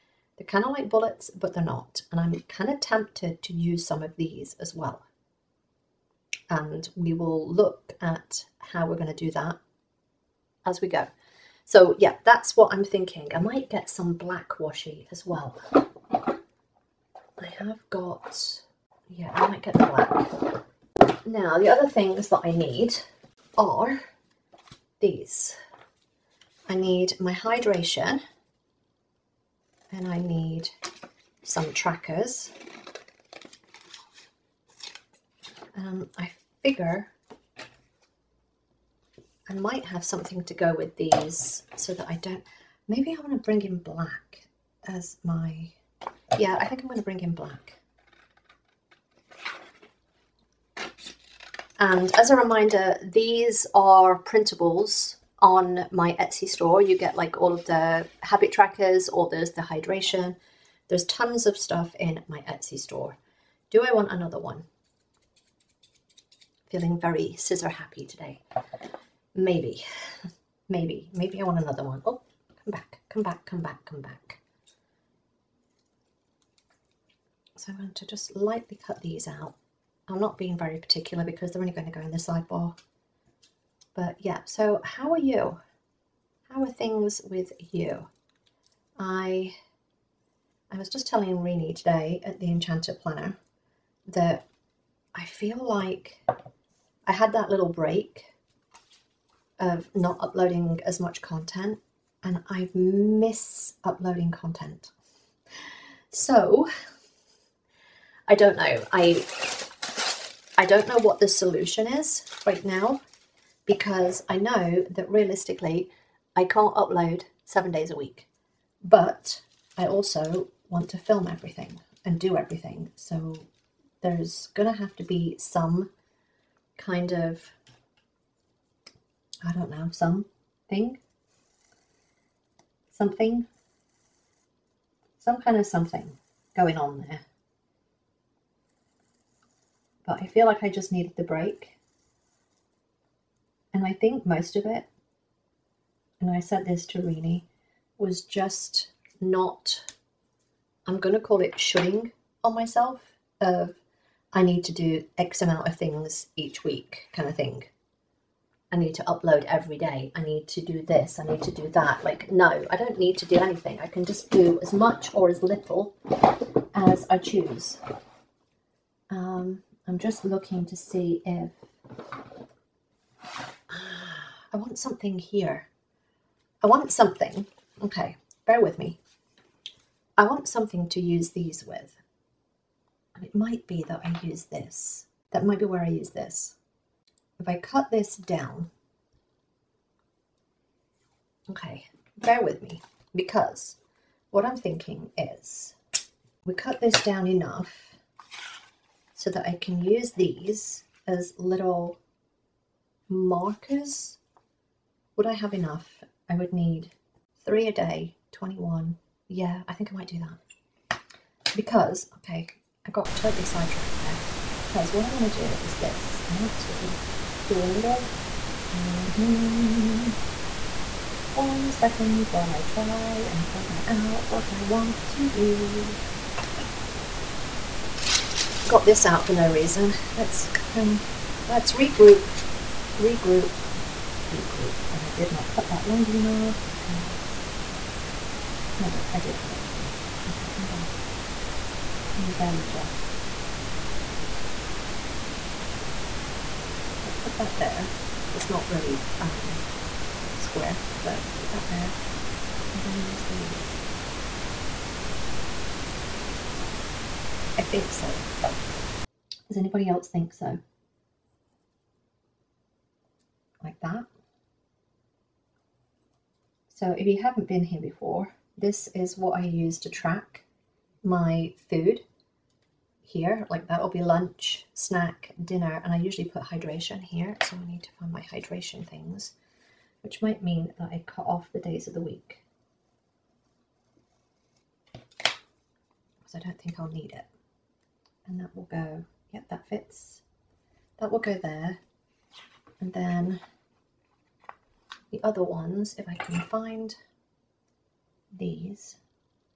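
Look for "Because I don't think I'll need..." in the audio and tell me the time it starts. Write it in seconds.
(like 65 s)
284 s.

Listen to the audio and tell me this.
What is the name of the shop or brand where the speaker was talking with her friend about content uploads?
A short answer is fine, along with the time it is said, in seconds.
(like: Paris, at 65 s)
The Enchanted Planner, at 92 s.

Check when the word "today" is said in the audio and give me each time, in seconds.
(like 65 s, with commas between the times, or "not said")
68 s, 91 s.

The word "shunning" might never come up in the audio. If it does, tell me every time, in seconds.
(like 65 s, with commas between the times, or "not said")
151 s.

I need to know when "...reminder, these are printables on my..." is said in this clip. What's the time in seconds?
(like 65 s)
52 s.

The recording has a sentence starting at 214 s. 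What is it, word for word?
Because what I want to do is this.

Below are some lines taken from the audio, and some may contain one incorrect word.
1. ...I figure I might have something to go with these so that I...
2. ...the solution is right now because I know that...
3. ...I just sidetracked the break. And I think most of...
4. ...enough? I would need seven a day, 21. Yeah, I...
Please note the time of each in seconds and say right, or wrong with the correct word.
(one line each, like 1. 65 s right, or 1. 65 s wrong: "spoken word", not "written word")
1. 36 s right
2. 111 s right
3. 140 s wrong: "needed", not "sidetracked"
4. 205 s wrong: "three", not "seven".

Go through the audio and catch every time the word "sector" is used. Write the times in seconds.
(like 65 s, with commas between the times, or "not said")
not said.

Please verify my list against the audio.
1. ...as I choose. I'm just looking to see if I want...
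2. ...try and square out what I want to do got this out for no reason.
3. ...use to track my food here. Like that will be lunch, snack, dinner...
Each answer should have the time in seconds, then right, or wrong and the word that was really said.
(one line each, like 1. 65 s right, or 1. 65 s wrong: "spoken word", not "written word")
1. 166 s right
2. 222 s wrong: "figure", not "square"
3. 269 s right.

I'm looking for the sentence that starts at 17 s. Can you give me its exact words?
I have got yeah, I might get the black.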